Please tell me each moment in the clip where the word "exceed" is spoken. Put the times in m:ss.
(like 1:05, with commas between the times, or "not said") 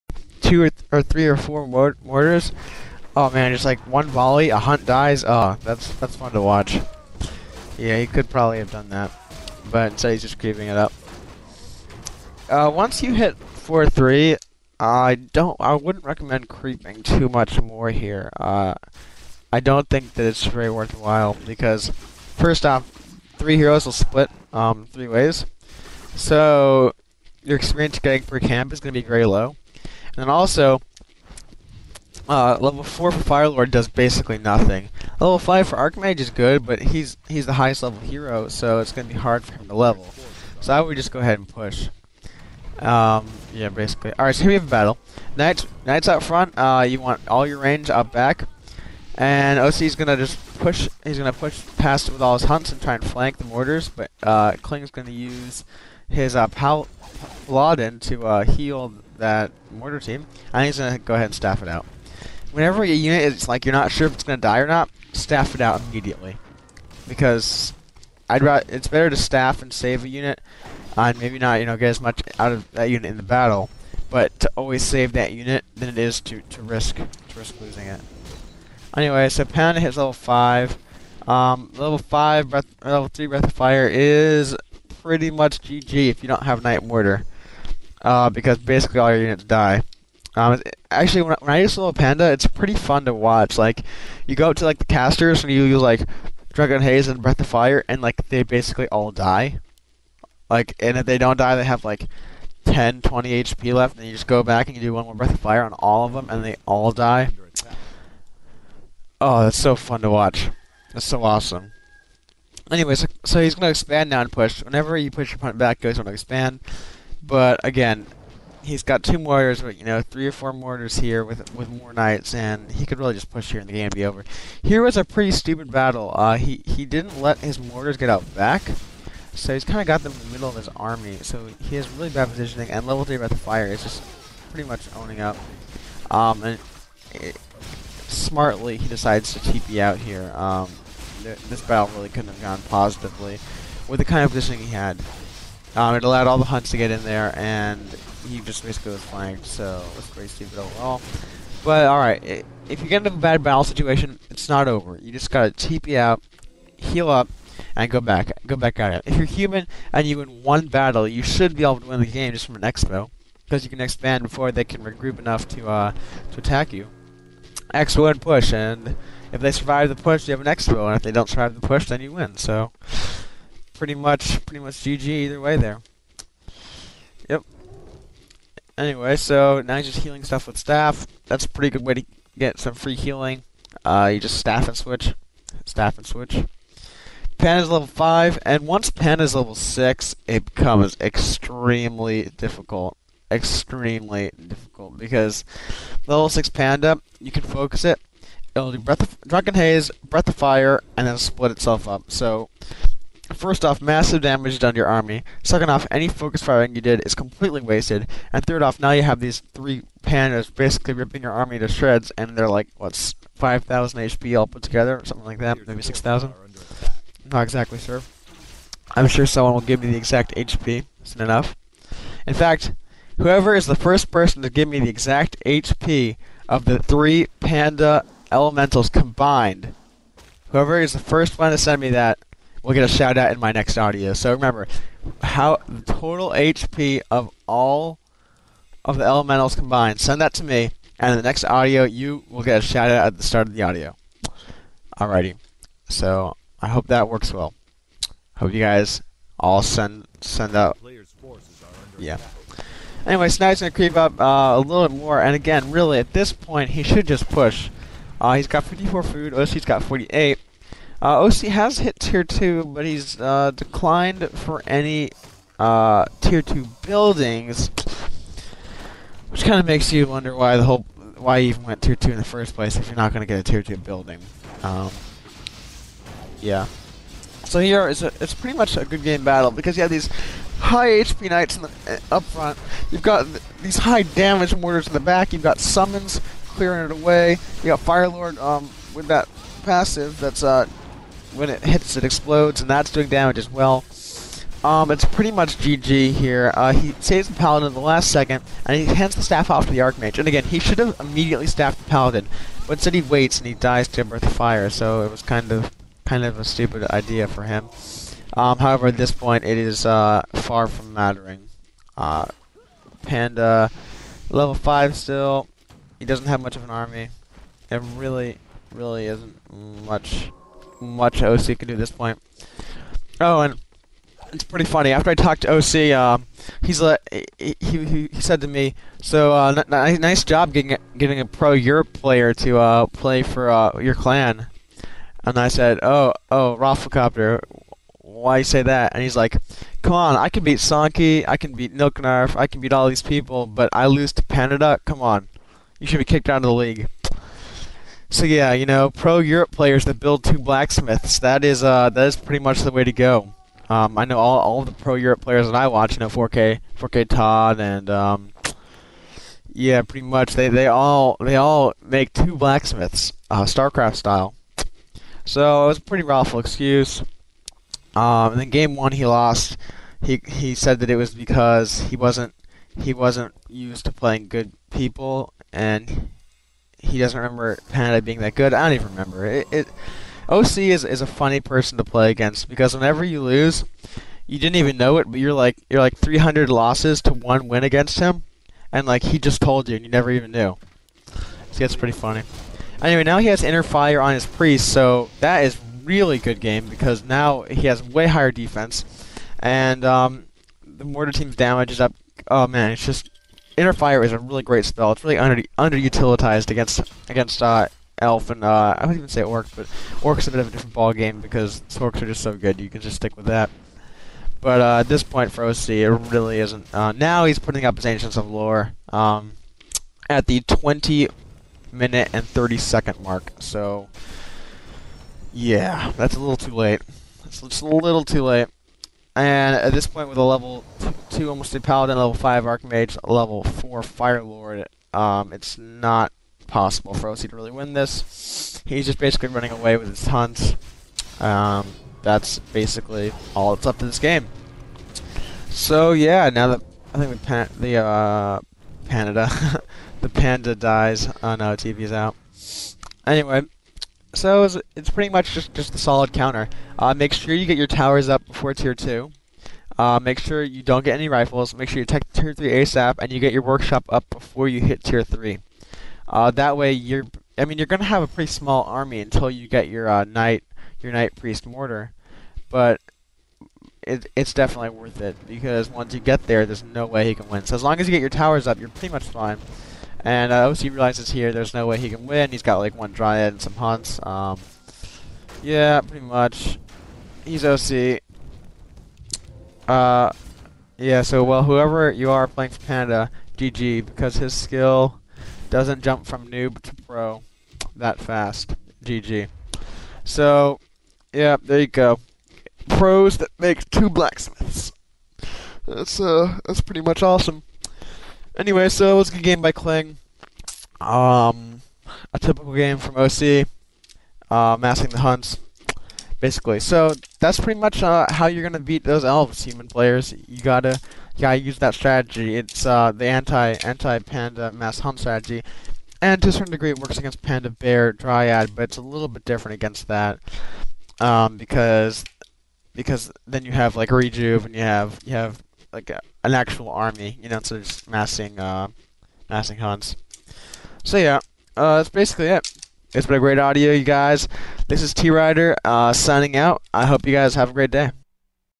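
not said.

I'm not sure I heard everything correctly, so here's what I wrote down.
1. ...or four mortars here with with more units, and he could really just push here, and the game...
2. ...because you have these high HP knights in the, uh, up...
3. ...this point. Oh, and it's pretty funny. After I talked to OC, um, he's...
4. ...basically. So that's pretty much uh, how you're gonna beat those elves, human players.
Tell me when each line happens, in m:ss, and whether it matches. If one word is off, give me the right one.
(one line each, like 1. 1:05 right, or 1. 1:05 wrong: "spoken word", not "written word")
1. 2:00 wrong: "knights", not "units"
2. 4:39 right
3. 5:21 right
4. 8:36 right.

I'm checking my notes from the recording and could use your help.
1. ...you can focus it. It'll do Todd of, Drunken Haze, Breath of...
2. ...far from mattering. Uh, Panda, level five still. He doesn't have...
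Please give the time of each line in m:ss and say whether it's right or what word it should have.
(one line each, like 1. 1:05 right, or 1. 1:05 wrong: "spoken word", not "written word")
1. 3:17 wrong: "Breath", not "Todd"
2. 5:10 right.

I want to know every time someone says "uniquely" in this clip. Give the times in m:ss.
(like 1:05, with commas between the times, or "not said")
not said.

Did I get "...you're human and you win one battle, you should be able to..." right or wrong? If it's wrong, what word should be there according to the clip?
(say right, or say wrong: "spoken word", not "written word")
right.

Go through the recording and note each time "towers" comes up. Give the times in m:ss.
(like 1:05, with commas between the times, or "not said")
7:37, 7:58.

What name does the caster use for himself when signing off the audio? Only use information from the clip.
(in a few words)
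T Rider.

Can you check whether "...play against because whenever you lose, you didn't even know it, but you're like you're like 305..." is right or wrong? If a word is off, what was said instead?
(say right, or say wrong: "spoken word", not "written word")
wrong: "300", not "305".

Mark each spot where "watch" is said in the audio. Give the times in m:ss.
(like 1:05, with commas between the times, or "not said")
0:06, 1:33, 1:50, 5:55.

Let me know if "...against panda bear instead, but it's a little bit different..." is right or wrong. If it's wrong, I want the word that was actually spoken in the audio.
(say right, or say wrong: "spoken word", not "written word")
wrong: "dryad", not "instead".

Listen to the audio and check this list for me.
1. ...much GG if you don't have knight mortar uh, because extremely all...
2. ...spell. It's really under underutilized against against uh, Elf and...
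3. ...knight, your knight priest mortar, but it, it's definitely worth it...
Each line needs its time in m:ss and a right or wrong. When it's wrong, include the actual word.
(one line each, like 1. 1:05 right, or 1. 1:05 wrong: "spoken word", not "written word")
1. 1:25 wrong: "basically", not "extremely"
2. 6:44 right
3. 7:50 right.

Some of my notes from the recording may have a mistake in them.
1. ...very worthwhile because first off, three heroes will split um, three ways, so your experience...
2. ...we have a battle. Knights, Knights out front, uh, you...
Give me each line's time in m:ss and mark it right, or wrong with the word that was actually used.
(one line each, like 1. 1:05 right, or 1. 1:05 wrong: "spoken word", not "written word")
1. 0:20 right
2. 0:44 right.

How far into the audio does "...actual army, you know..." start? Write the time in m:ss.
8:56.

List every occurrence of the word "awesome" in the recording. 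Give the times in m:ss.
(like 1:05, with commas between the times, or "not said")
1:51, 8:27.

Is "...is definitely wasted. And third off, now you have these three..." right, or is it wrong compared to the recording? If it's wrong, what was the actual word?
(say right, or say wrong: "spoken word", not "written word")
wrong: "completely", not "definitely".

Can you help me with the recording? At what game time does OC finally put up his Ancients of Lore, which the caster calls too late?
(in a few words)
20 minutes 30 seconds.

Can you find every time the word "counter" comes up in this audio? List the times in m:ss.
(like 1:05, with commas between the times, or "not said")
7:36.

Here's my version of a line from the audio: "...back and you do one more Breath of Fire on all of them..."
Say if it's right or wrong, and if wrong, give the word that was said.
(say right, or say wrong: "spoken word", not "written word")
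right.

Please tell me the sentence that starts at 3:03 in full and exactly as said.
Uh, you just staff and switch.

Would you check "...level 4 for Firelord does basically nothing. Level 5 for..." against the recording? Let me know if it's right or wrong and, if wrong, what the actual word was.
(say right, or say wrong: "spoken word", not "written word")
right.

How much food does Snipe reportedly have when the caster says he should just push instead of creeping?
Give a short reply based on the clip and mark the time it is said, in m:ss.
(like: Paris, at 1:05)
54, at 4:18.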